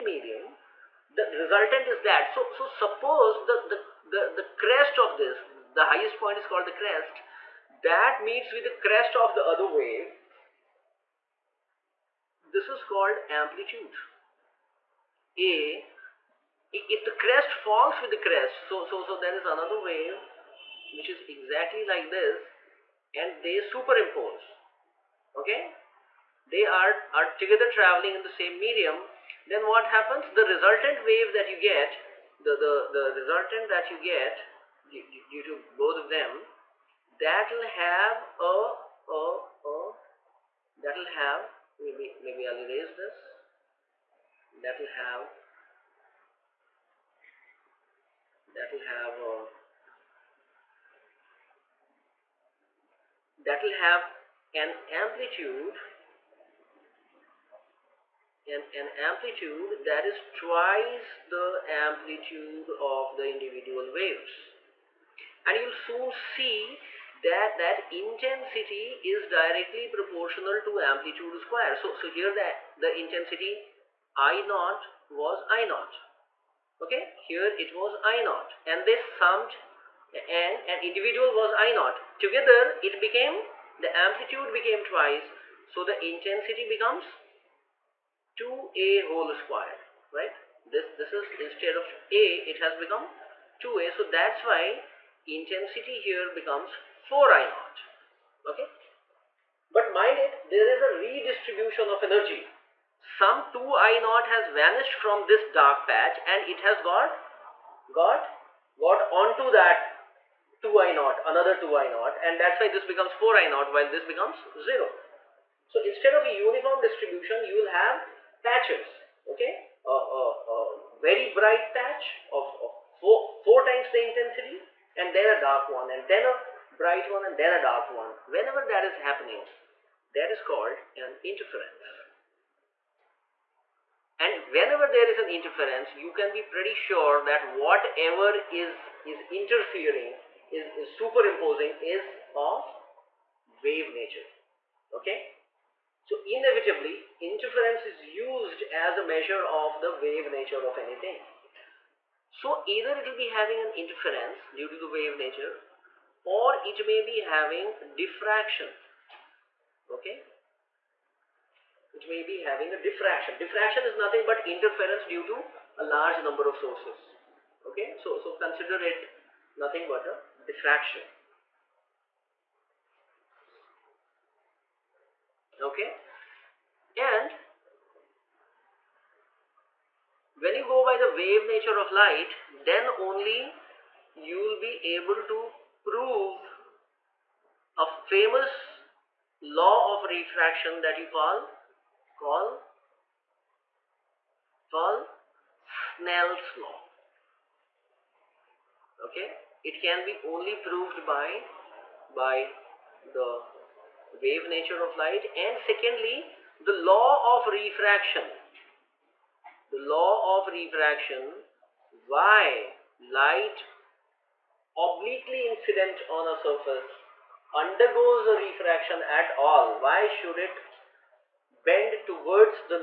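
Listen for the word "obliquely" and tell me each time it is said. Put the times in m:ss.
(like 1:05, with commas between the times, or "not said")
3:34.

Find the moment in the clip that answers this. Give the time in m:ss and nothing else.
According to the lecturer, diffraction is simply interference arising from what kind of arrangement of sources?
2:45.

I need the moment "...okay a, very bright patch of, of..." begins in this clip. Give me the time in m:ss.
1:59.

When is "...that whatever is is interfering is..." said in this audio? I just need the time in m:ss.
2:17.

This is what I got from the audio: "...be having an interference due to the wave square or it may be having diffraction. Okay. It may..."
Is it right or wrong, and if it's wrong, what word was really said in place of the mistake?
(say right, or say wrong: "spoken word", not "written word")
wrong: "nature", not "square".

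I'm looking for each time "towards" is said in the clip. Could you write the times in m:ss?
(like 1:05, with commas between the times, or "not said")
3:42.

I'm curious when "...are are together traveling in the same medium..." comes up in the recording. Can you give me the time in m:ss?
0:26.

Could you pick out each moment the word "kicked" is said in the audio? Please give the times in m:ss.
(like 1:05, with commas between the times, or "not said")
not said.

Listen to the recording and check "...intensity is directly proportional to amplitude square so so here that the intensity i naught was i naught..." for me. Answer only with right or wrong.
right.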